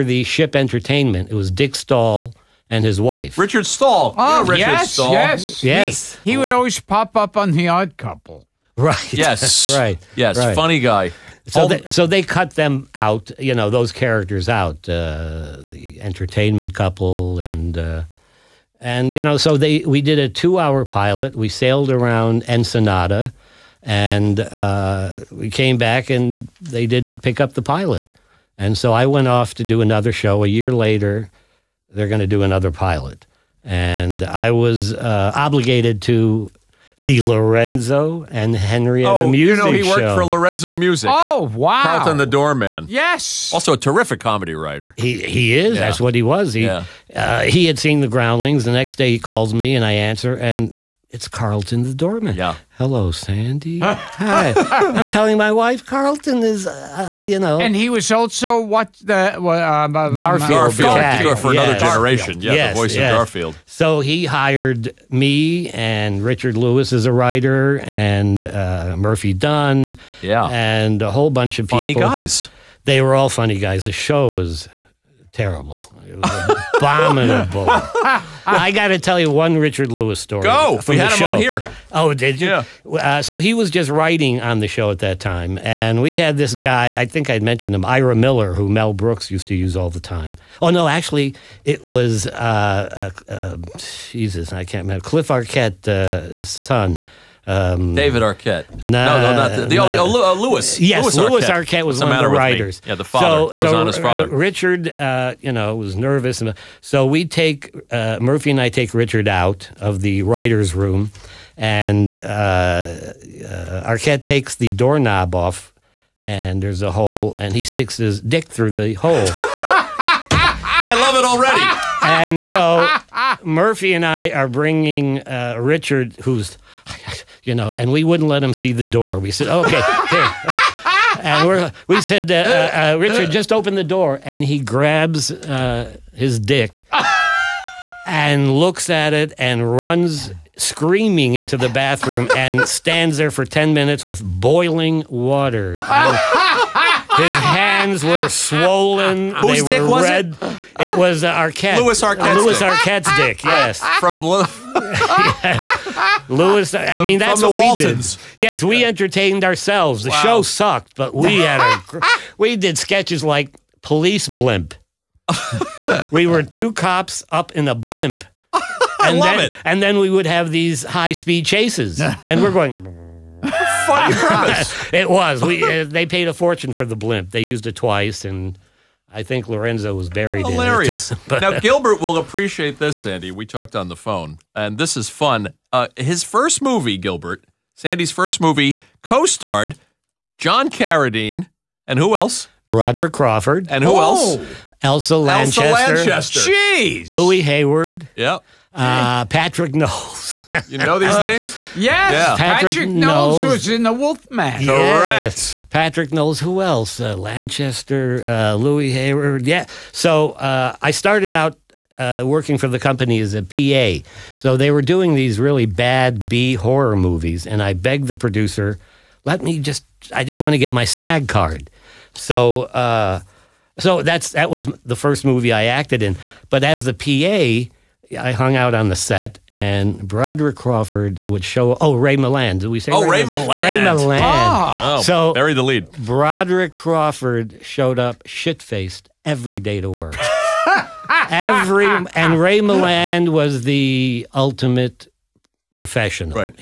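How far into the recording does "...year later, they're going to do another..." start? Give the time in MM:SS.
00:30.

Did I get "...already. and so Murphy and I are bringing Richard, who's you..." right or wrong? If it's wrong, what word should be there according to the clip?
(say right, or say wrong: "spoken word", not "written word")
right.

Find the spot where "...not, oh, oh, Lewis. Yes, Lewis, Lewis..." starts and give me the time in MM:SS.
01:39.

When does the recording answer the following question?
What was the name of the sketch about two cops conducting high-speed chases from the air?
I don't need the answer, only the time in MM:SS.
02:43.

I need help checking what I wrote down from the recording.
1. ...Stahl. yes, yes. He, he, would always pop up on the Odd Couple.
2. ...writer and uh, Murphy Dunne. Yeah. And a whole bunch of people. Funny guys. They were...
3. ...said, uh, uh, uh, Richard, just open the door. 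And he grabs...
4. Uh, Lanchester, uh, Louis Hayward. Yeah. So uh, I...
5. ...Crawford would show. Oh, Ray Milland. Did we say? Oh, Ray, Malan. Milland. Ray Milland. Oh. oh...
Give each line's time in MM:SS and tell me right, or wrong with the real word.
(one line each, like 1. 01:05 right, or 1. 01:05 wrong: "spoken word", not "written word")
1. 00:04 right
2. 01:07 right
3. 02:12 right
4. 03:26 right
5. 03:50 right.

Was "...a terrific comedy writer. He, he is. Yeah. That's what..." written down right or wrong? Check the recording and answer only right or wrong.
right.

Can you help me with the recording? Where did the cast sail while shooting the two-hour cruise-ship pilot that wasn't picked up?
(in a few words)
Ensenada.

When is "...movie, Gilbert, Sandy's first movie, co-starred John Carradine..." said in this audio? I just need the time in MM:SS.
03:06.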